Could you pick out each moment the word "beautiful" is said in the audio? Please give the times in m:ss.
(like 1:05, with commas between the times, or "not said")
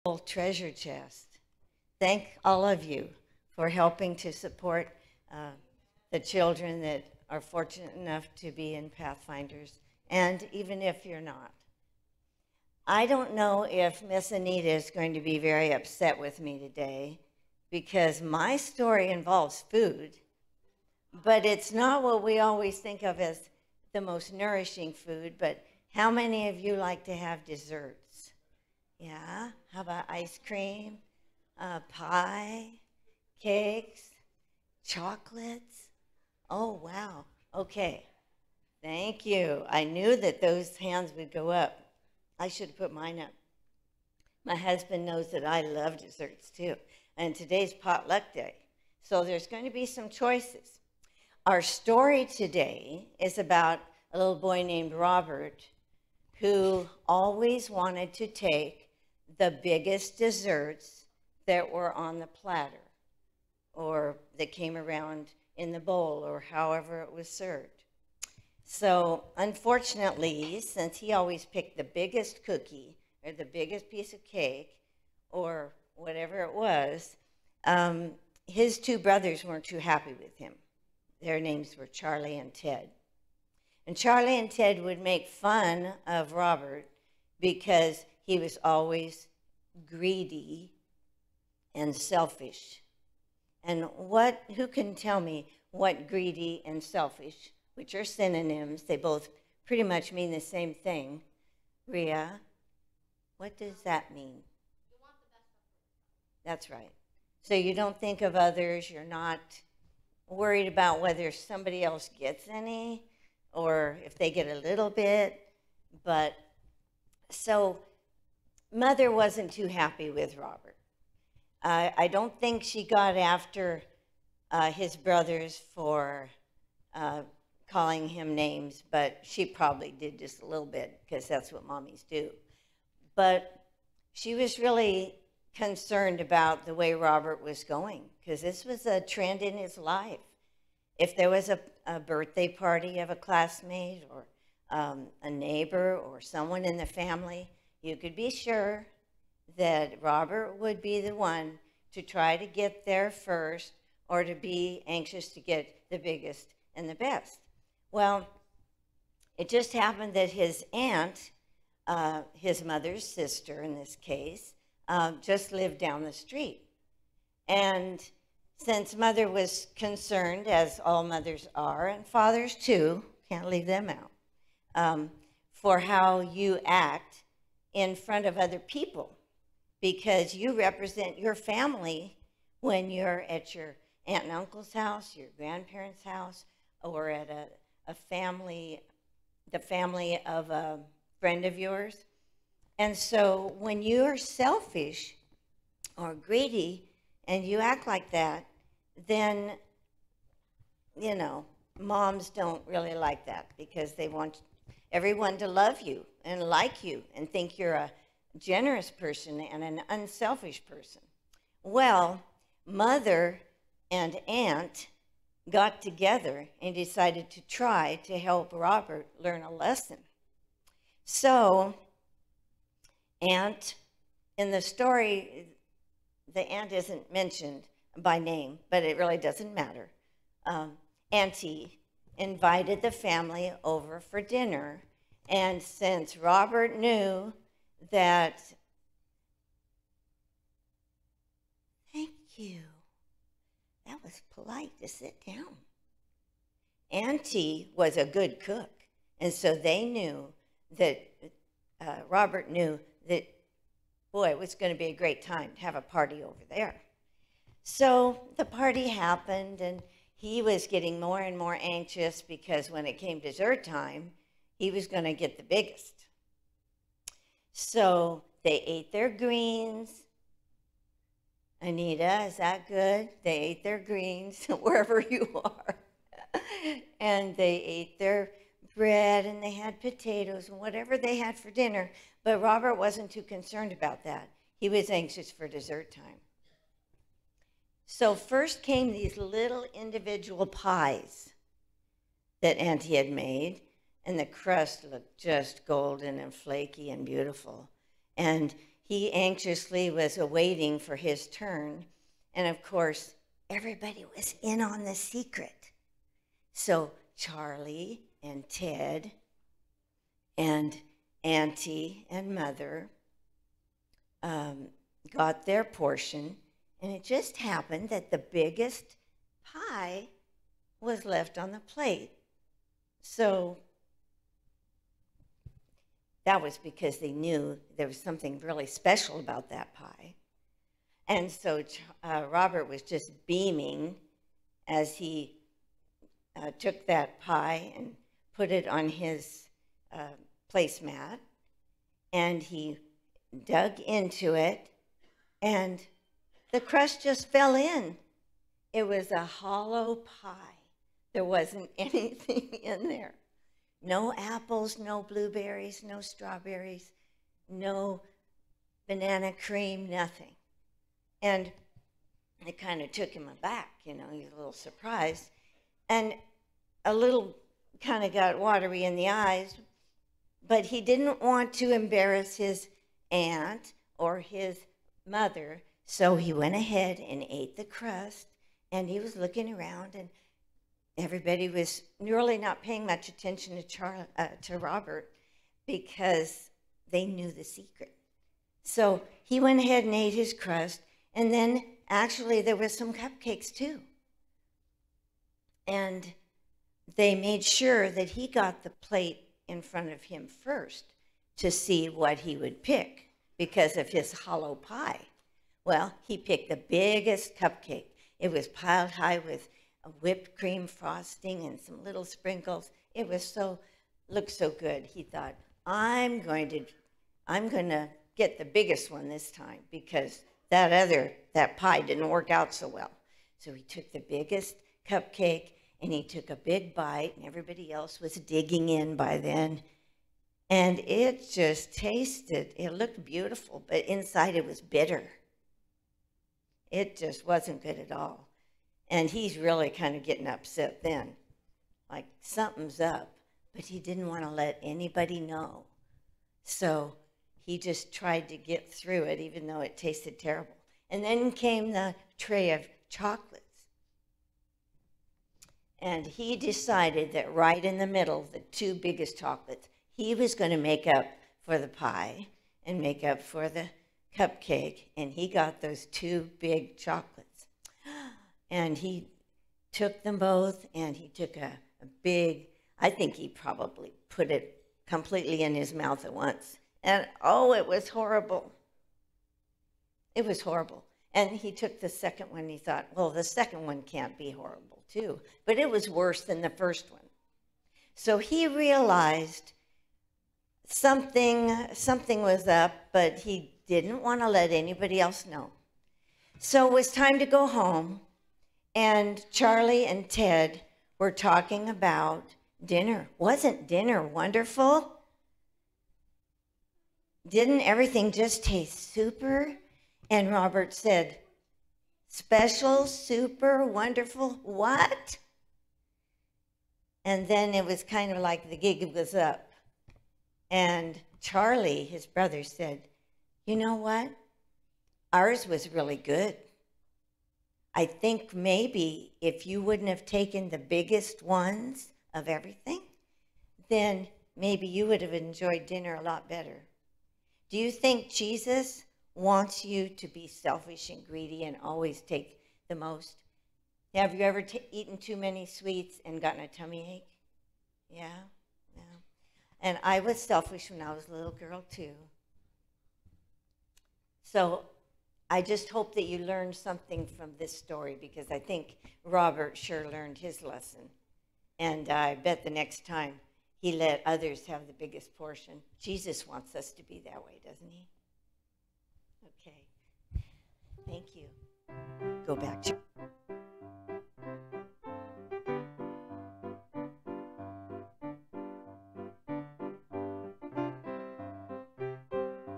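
4:57, 7:13.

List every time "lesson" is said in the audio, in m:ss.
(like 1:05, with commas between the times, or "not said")
3:39, 9:20.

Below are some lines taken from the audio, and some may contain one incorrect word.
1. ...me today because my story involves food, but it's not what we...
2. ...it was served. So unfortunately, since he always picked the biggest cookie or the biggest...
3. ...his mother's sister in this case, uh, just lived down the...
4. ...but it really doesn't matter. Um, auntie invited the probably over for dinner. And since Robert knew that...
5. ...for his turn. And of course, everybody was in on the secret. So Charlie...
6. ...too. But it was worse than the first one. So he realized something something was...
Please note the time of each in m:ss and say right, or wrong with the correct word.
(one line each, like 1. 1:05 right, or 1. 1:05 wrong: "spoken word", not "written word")
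1. 0:16 right
2. 1:07 right
3. 2:42 right
4. 3:48 wrong: "family", not "probably"
5. 5:00 right
6. 8:04 right.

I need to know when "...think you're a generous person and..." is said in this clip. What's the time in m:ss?
3:27.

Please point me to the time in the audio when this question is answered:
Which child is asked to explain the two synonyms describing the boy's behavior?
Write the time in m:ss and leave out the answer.
1:41.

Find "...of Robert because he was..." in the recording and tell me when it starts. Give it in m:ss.
1:26.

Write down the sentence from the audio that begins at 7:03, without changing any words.
So he took the biggest cupcake and he took a big bite and everybody else was digging in by then.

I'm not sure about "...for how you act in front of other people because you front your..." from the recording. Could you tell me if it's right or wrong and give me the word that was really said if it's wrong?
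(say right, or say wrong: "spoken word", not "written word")
wrong: "represent", not "front".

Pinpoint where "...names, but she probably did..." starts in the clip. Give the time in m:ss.
2:08.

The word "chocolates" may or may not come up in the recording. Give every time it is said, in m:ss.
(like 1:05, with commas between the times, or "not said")
0:34, 7:32, 7:39, 7:46.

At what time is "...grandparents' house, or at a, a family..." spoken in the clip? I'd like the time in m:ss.
3:05.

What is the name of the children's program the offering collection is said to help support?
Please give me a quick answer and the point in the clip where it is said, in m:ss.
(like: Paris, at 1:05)
Pathfinders, at 0:08.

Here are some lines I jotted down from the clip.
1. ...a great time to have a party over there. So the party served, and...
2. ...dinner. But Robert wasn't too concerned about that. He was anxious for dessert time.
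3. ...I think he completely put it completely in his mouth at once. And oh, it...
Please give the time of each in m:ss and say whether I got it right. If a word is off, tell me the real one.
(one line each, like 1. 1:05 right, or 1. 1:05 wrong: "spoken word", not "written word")
1. 4:14 wrong: "happened", not "served"
2. 4:41 right
3. 7:52 wrong: "probably", not "completely".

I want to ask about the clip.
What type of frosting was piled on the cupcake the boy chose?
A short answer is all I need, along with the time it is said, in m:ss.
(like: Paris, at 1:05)
Whipped cream frosting, at 6:49.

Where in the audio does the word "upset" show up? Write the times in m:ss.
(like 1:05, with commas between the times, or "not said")
0:15, 7:20.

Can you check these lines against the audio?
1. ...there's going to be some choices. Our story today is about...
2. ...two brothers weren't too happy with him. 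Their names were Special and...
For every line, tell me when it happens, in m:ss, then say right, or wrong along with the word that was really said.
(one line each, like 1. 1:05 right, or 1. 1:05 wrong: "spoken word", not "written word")
1. 0:49 right
2. 1:18 wrong: "Charlie", not "Special".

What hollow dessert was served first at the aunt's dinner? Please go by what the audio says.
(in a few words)
Individual pies.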